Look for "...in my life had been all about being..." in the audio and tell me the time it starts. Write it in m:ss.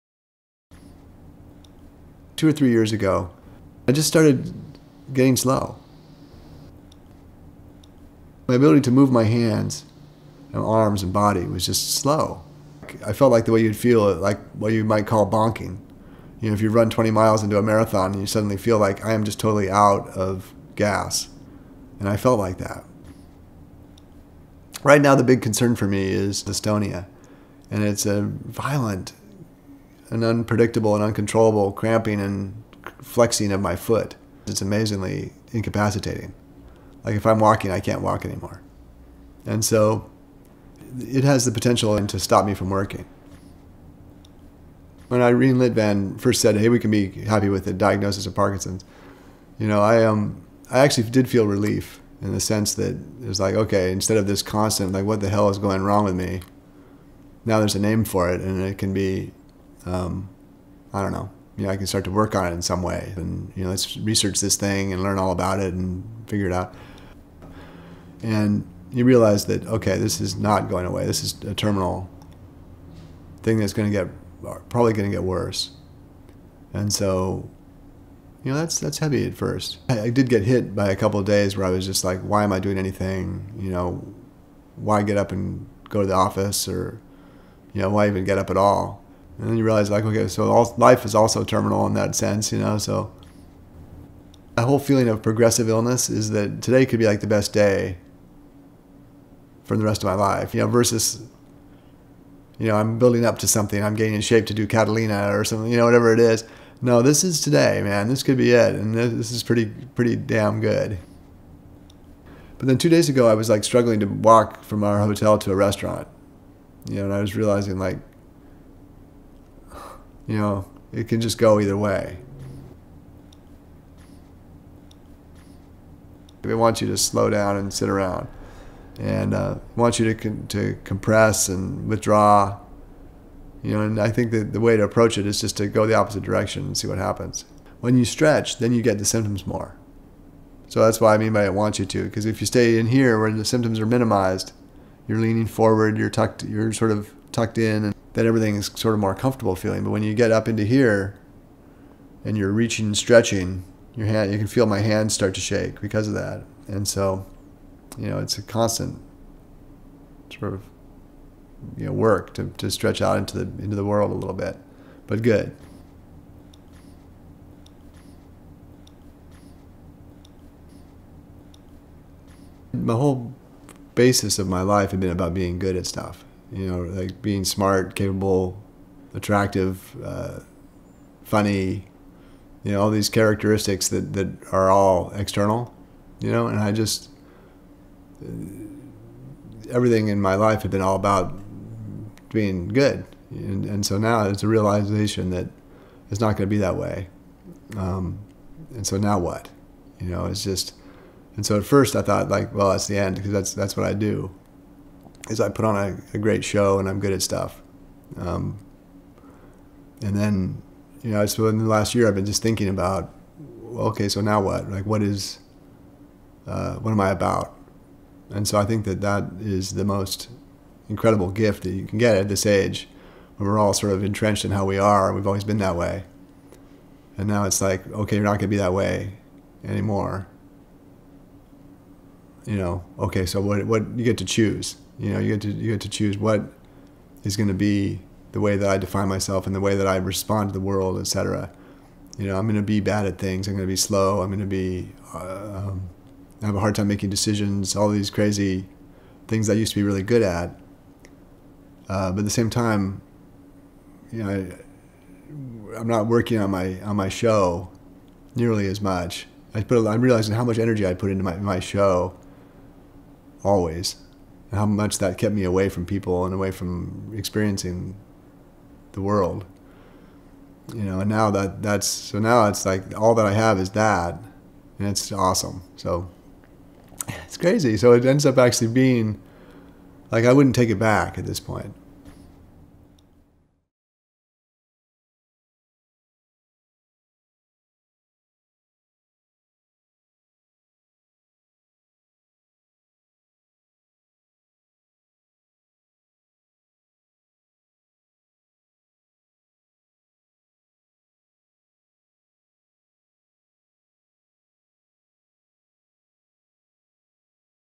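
3:10.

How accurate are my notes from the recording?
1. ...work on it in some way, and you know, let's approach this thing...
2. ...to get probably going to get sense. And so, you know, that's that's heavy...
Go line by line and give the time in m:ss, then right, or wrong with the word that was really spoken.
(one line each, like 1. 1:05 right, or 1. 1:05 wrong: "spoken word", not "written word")
1. 1:02 wrong: "research", not "approach"
2. 1:13 wrong: "worse", not "sense".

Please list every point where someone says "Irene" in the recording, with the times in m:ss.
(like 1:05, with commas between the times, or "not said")
0:45.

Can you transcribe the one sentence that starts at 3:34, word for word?
Like, what is, uh, what am I about?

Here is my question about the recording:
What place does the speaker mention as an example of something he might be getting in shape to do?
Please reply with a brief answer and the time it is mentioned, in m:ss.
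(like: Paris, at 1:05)
Catalina, at 1:44.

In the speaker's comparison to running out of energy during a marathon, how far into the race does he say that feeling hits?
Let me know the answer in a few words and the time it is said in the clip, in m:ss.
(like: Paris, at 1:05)
20 miles, at 0:16.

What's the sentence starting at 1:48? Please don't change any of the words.
This could be it, and this is pretty, pretty damn good.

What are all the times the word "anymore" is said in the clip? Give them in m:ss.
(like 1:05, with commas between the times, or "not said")
0:38, 3:49.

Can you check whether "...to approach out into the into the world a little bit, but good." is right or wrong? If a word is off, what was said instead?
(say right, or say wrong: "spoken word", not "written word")
wrong: "stretch", not "approach".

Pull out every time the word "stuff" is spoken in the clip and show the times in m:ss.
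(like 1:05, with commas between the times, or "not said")
2:55, 3:27.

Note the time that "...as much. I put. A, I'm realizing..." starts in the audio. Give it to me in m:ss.
4:18.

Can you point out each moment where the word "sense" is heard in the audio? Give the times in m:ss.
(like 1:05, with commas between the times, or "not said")
0:52, 1:32.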